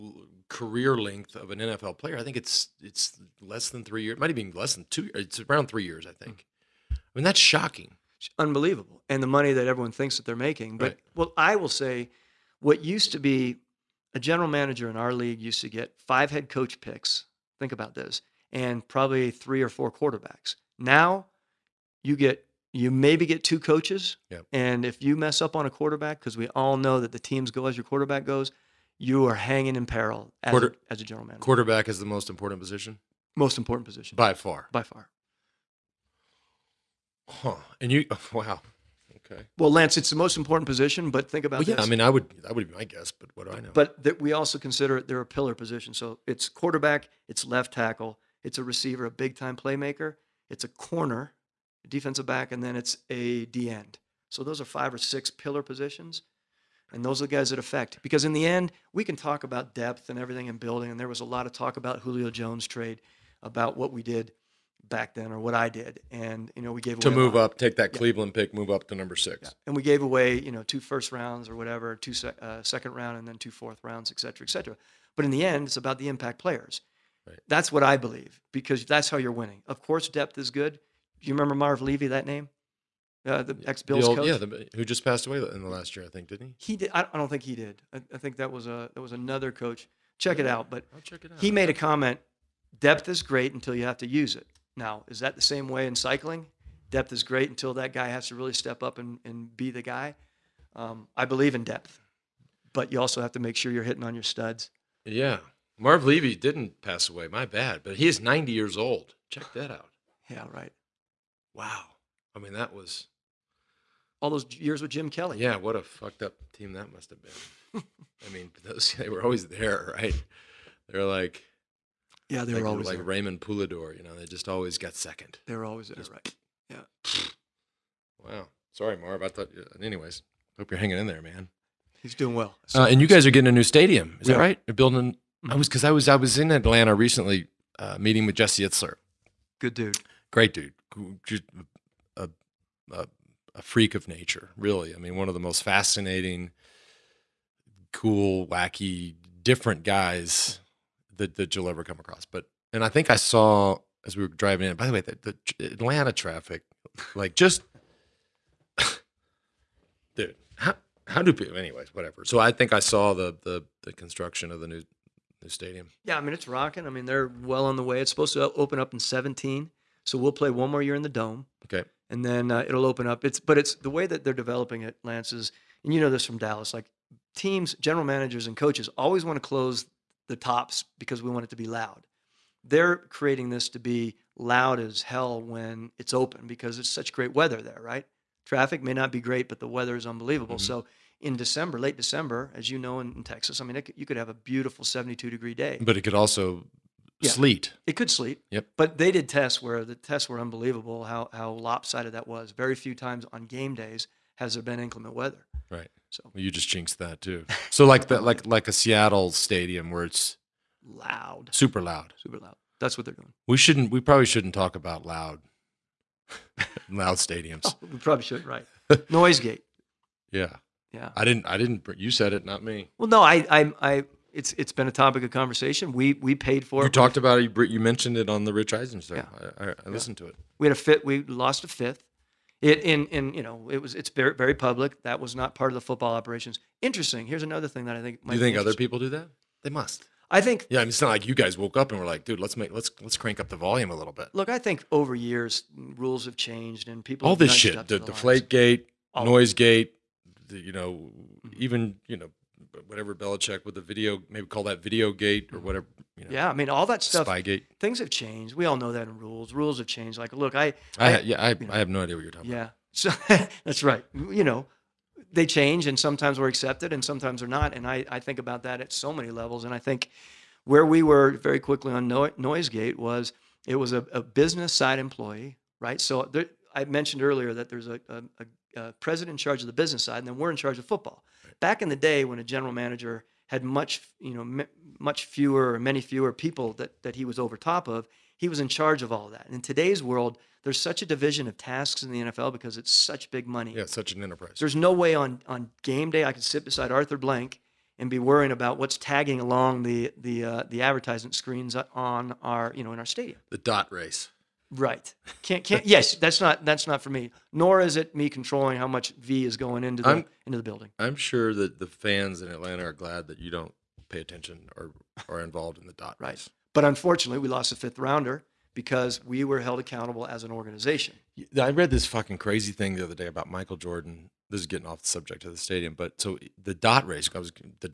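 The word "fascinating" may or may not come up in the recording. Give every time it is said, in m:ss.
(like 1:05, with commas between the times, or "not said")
2:25.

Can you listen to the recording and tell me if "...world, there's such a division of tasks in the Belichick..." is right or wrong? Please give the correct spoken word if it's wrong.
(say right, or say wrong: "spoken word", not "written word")
wrong: "NFL", not "Belichick".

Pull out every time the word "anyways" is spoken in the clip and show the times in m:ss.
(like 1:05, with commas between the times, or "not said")
2:09, 2:41.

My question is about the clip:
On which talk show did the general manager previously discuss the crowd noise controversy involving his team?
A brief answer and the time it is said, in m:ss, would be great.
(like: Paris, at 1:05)
Rich Eisen show, at 3:48.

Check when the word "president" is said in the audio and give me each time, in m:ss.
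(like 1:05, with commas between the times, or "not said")
4:39.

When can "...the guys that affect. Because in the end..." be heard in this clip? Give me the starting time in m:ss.
0:57.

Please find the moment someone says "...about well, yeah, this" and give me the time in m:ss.
0:41.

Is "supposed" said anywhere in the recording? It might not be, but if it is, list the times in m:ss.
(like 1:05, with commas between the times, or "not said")
2:48.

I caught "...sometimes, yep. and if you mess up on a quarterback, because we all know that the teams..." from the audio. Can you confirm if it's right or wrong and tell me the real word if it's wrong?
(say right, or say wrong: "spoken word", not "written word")
wrong: "coaches", not "sometimes".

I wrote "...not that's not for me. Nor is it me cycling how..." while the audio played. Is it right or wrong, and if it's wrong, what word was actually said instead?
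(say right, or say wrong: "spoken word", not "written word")
wrong: "controlling", not "cycling".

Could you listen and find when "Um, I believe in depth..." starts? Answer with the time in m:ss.
1:40.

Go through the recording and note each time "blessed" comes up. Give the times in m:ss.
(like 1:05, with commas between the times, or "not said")
not said.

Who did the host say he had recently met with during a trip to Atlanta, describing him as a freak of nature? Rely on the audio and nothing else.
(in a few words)
Jesse Itzler.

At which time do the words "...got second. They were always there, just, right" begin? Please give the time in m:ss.
2:04.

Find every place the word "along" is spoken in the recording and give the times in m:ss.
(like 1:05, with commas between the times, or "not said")
4:59.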